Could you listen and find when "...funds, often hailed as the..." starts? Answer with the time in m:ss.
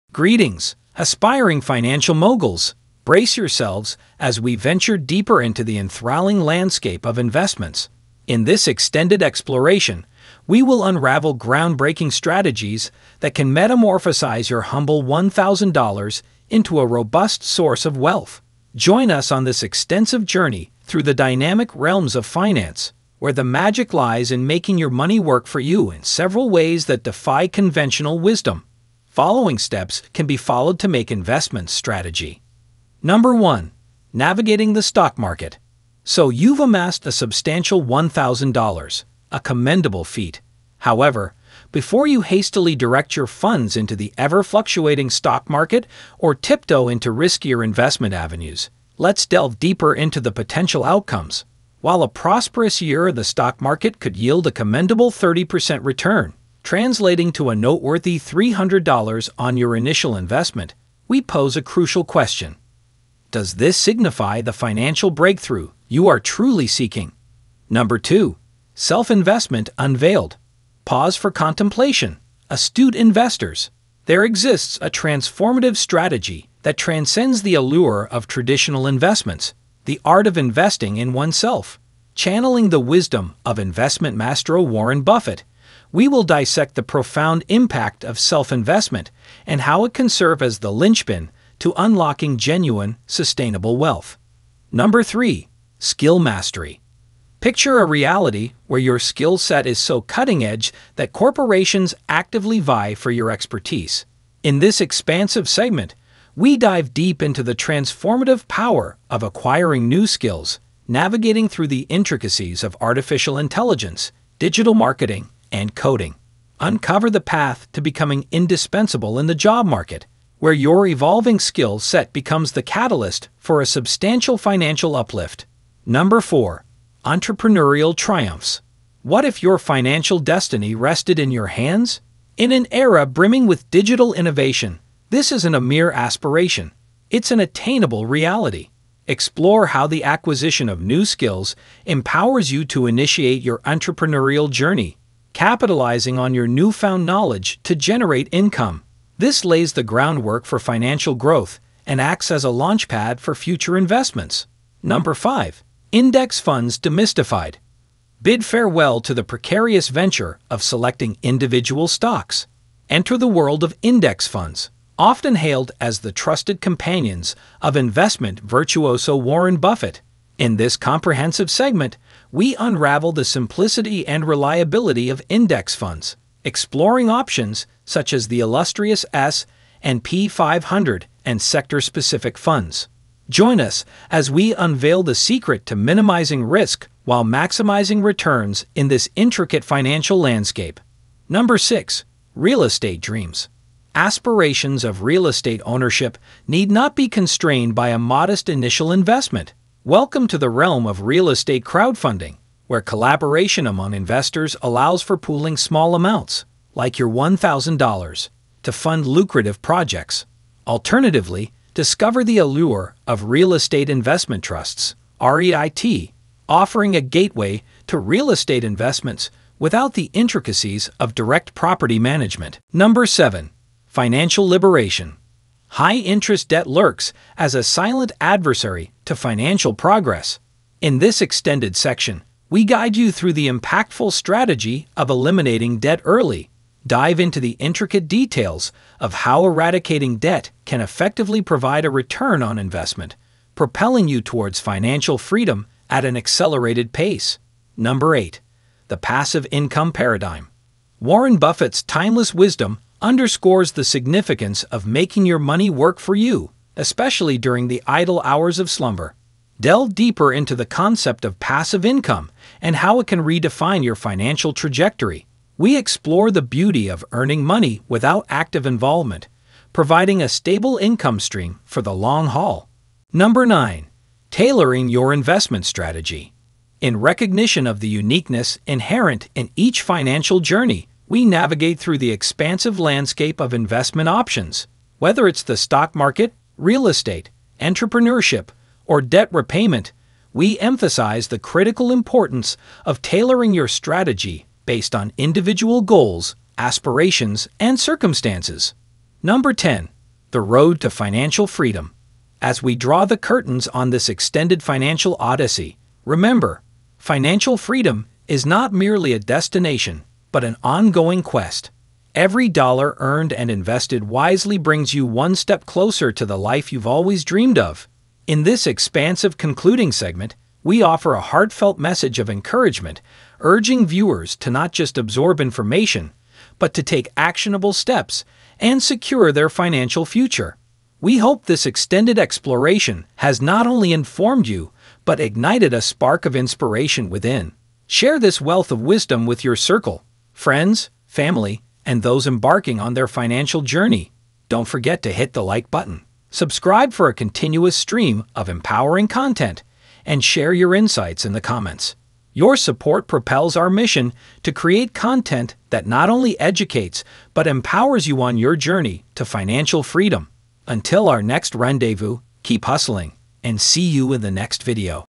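2:44.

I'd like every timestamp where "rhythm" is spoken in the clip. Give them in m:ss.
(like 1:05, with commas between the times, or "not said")
not said.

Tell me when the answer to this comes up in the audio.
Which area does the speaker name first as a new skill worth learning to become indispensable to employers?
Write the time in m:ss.
1:52.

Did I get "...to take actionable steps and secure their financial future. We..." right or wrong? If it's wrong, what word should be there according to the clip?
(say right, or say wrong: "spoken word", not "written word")
right.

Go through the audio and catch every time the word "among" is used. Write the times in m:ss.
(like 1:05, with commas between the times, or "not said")
3:23.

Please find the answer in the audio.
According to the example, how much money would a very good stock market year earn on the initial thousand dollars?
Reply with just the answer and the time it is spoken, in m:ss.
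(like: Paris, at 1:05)
$300, at 0:58.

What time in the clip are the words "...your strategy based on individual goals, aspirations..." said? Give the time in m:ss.
4:53.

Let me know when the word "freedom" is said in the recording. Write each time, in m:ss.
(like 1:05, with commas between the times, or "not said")
4:05, 5:01, 5:07, 5:59.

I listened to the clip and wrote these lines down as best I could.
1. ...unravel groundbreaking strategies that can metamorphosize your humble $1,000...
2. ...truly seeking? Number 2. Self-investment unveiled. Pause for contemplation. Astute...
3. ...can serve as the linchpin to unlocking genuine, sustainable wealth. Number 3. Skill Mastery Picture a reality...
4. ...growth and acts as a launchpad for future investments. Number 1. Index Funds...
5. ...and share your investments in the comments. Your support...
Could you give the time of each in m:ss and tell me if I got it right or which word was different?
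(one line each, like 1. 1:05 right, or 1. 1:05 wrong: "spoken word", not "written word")
1. 0:10 right
2. 1:06 right
3. 1:29 right
4. 2:31 wrong: "5", not "1"
5. 5:50 wrong: "insights", not "investments".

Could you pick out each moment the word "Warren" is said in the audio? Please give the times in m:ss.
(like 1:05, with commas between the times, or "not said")
1:24, 2:49, 4:11.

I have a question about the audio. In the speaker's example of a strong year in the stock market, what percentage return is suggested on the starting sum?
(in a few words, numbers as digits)
30%.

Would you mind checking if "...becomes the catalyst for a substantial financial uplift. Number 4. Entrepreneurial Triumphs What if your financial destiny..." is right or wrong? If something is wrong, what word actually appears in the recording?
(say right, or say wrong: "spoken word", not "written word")
right.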